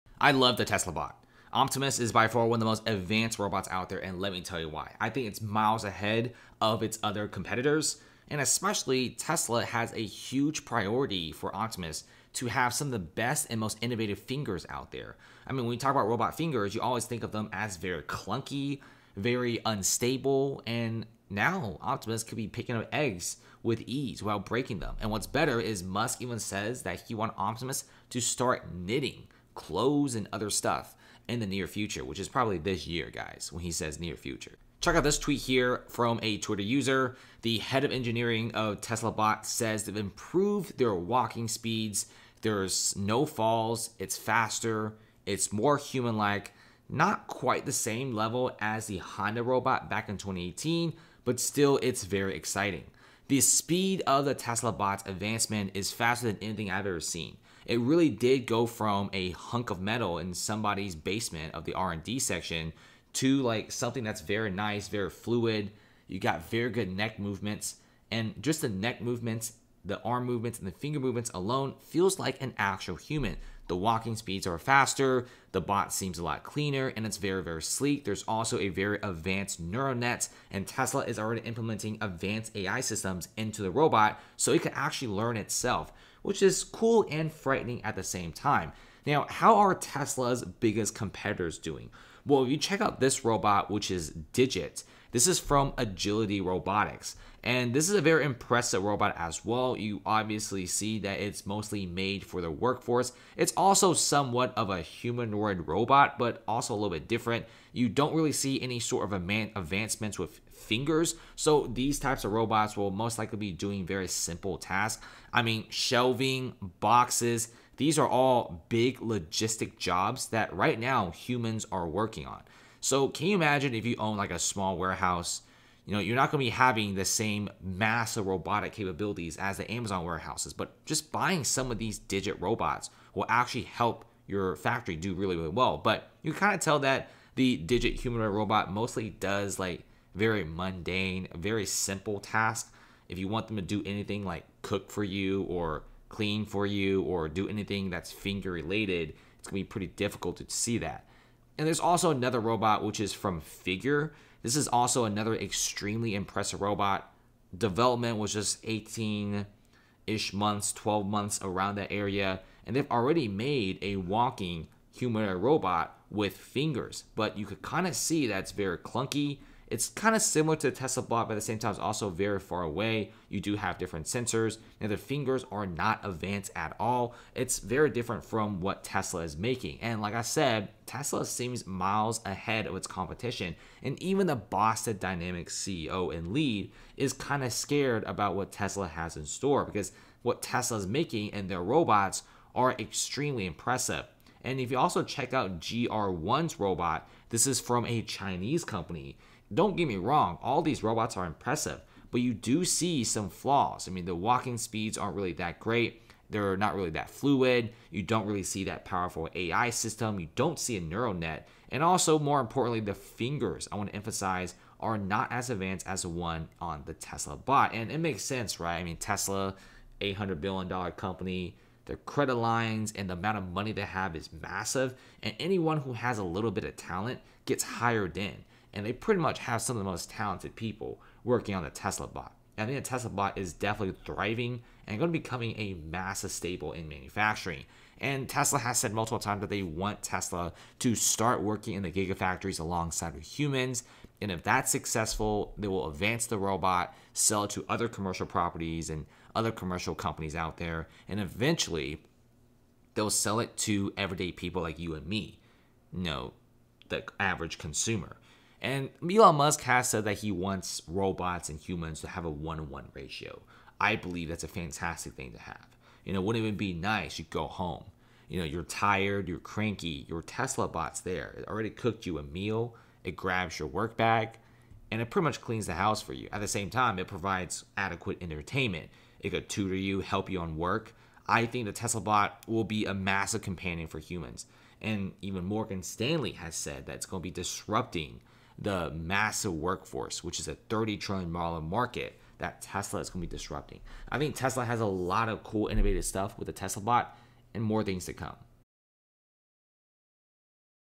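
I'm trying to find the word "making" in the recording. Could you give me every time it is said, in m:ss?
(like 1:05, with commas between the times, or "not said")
2:59, 3:10.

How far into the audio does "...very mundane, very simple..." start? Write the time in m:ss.
2:20.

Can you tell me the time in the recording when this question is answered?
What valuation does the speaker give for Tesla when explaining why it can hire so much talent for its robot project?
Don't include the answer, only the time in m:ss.
3:39.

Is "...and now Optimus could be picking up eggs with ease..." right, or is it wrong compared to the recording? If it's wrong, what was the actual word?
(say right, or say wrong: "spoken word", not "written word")
right.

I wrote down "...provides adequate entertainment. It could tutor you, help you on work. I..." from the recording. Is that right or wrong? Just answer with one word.
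right.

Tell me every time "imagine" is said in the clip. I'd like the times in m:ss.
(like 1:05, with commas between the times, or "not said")
2:03.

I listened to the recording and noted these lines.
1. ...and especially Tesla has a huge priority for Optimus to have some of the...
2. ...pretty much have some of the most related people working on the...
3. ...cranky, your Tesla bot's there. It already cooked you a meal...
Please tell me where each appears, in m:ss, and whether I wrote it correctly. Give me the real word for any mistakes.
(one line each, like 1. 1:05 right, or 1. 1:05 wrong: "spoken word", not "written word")
1. 0:08 right
2. 3:48 wrong: "talented", not "related"
3. 4:29 right.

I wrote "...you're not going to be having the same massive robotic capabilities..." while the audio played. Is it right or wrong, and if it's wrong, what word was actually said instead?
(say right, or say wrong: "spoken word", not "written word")
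right.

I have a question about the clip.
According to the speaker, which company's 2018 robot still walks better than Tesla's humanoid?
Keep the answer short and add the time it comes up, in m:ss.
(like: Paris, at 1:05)
Honda, at 0:48.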